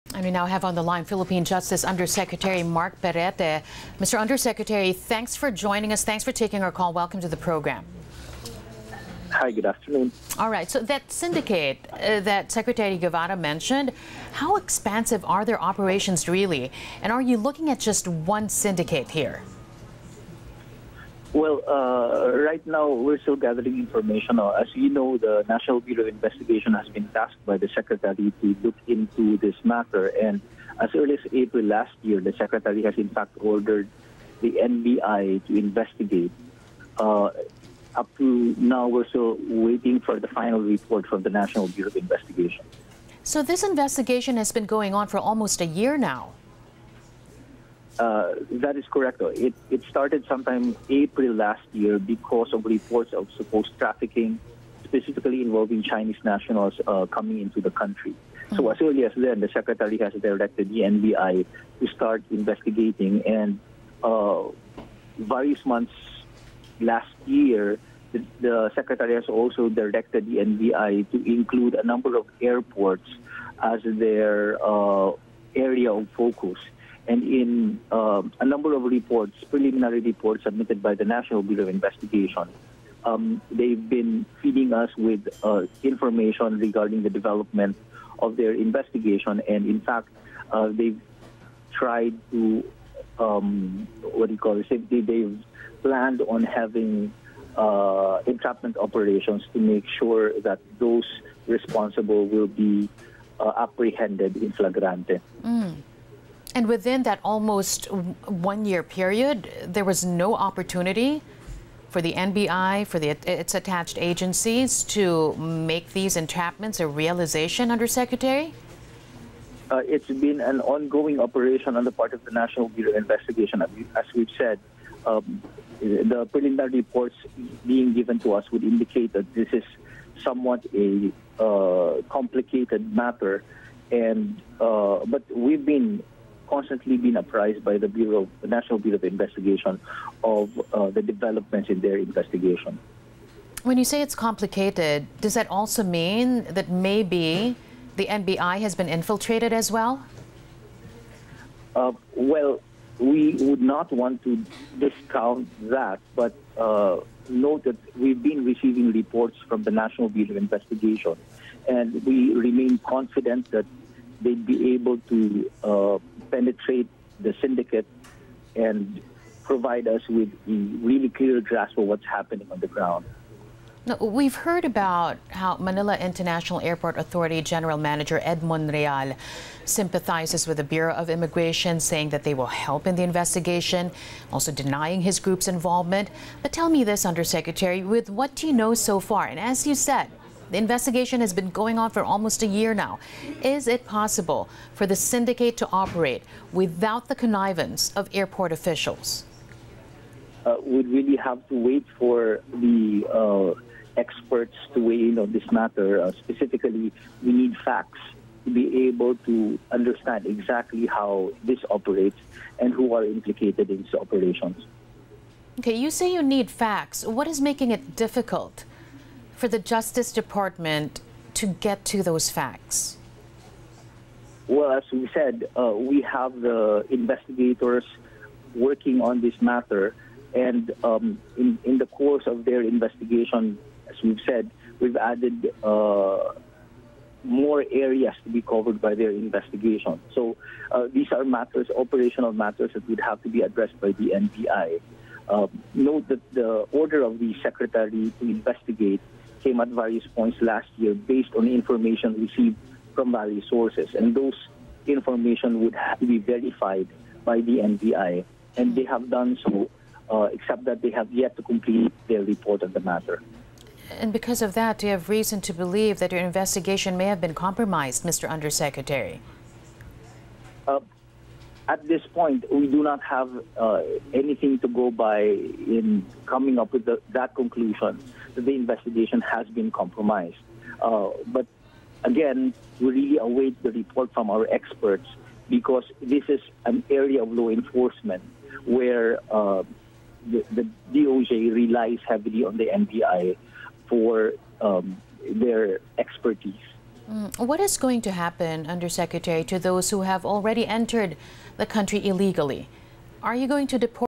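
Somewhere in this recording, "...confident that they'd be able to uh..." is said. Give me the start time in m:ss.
2:42.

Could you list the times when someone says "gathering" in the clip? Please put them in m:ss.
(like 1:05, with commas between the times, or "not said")
0:23.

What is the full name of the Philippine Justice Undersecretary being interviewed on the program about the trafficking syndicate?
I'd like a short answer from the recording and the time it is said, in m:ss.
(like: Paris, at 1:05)
Markk Perete, at 0:02.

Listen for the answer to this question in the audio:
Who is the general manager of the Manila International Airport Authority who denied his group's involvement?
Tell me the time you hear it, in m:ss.
2:58.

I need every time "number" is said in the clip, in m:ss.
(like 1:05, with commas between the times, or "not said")
1:11, 1:18.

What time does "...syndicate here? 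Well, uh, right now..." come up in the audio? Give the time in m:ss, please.
0:18.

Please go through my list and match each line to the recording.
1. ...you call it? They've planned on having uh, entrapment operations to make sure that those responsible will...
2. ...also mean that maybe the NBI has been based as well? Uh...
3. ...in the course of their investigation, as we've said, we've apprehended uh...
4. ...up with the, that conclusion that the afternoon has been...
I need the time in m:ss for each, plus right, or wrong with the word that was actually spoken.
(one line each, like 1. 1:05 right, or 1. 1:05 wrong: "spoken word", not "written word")
1. 1:34 right
2. 2:25 wrong: "infiltrated", not "based"
3. 3:51 wrong: "added", not "apprehended"
4. 4:36 wrong: "investigation", not "afternoon".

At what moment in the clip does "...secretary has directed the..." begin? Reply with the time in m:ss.
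0:59.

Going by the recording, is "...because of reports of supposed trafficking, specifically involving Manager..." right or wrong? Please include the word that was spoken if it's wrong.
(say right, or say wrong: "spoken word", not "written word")
wrong: "Chinese", not "Manager".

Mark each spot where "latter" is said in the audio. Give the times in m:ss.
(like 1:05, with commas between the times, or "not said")
not said.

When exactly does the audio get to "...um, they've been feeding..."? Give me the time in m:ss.
1:23.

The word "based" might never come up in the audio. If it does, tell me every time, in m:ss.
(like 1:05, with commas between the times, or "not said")
4:10.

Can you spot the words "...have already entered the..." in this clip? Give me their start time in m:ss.
5:00.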